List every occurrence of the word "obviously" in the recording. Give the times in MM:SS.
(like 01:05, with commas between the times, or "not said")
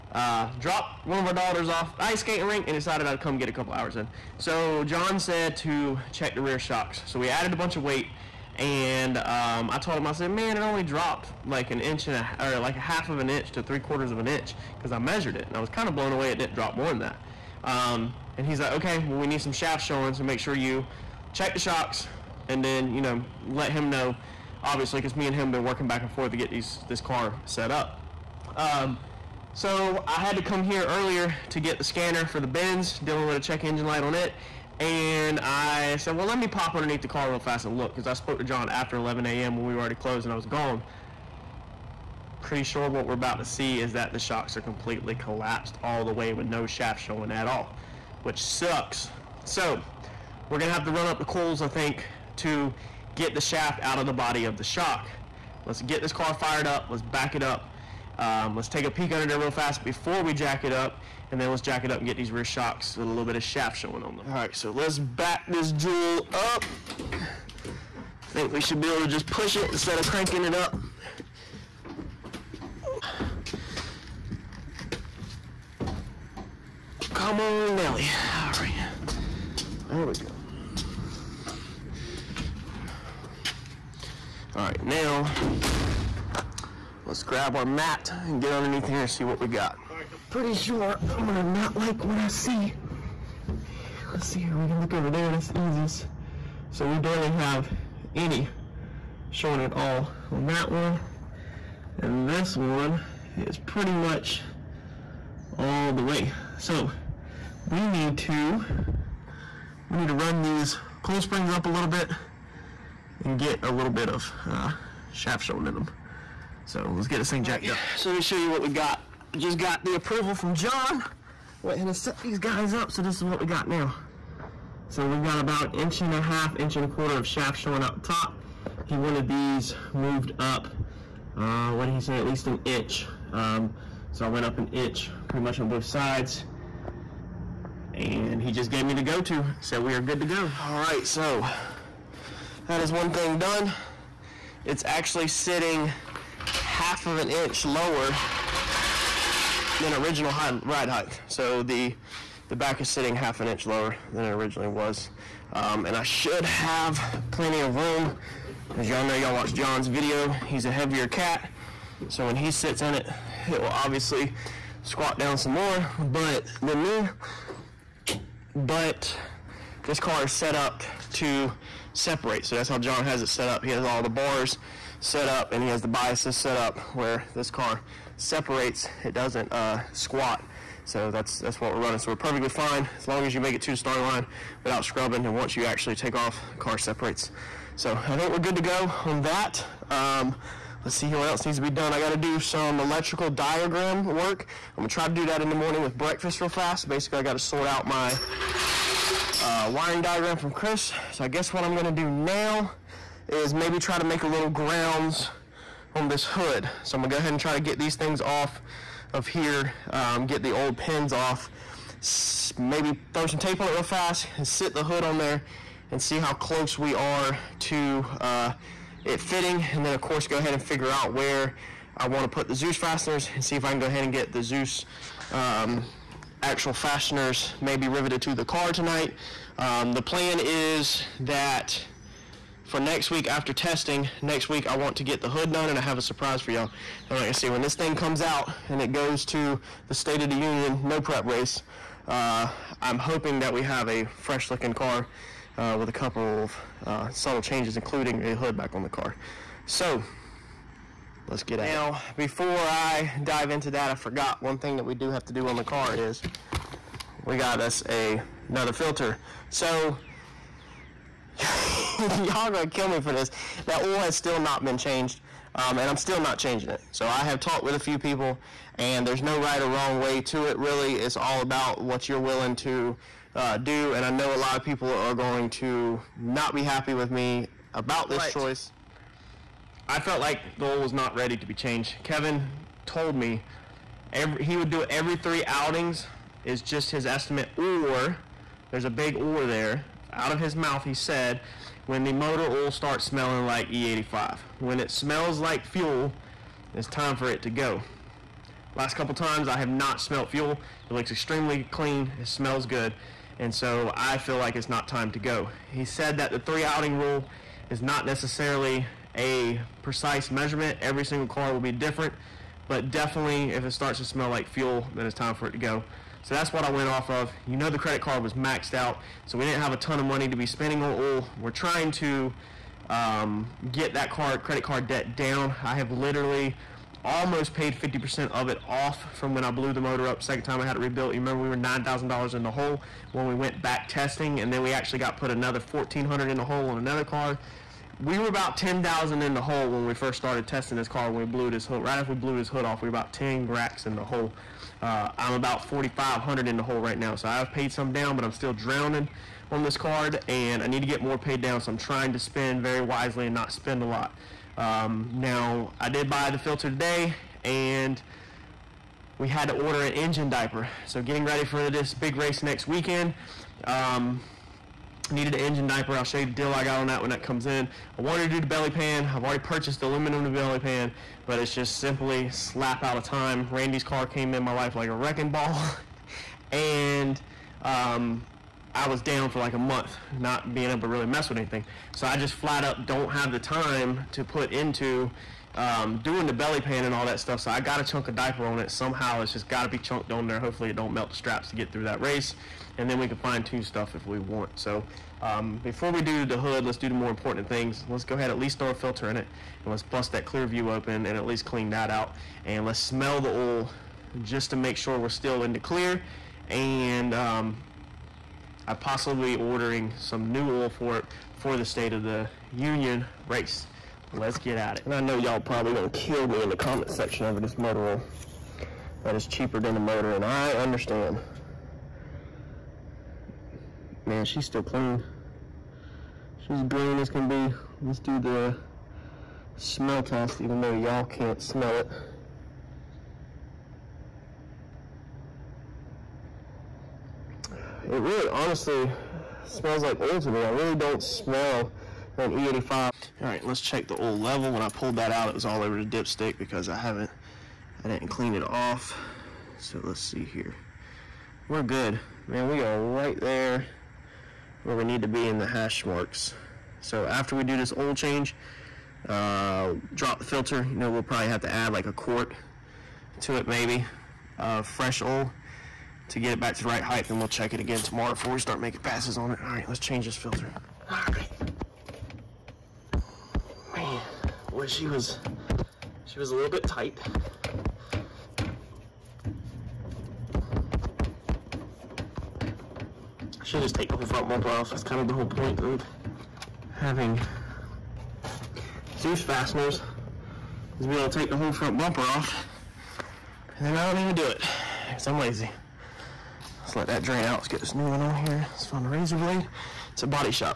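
00:24, 02:43.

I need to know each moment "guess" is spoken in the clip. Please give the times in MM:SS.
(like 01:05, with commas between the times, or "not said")
03:21.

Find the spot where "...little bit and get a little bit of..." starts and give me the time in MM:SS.
01:51.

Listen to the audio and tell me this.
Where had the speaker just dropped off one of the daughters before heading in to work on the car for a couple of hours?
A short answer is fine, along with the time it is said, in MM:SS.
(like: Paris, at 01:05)
ice skating rink, at 00:01.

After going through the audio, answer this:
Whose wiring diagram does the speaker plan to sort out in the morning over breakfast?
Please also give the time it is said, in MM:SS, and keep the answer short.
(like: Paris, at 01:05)
Chris, at 03:20.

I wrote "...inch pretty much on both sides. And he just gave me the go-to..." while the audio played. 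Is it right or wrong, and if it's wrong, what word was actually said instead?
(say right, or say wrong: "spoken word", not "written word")
right.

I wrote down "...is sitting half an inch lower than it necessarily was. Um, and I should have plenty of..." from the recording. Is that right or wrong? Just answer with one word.
wrong.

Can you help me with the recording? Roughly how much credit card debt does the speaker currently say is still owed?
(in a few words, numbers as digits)
4,500.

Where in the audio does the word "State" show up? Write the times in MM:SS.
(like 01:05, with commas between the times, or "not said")
03:59, 06:51.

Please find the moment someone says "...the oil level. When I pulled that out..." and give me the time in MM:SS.
07:23.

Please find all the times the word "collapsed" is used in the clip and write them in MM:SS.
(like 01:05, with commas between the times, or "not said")
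00:45.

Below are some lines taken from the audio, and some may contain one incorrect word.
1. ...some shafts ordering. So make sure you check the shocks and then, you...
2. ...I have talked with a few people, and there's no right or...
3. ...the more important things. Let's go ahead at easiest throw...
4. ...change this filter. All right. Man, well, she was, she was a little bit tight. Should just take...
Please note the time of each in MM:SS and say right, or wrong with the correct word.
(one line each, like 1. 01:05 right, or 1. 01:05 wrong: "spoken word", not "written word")
1. 00:19 wrong: "showing", not "ordering"
2. 04:27 right
3. 06:36 wrong: "least", not "easiest"
4. 07:49 right.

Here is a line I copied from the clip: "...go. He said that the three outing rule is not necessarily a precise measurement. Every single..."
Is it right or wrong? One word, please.
right.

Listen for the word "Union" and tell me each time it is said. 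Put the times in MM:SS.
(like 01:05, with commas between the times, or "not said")
04:00, 06:52.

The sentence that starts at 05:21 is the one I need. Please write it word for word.
We're trying to um, get that card credit card debt down.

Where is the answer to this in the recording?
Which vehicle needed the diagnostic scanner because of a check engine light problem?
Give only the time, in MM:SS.
00:32.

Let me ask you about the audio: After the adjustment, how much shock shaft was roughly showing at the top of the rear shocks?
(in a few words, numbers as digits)
1 1/4 to 1 1/2 inches.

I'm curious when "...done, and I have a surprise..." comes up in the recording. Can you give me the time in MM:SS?
03:55.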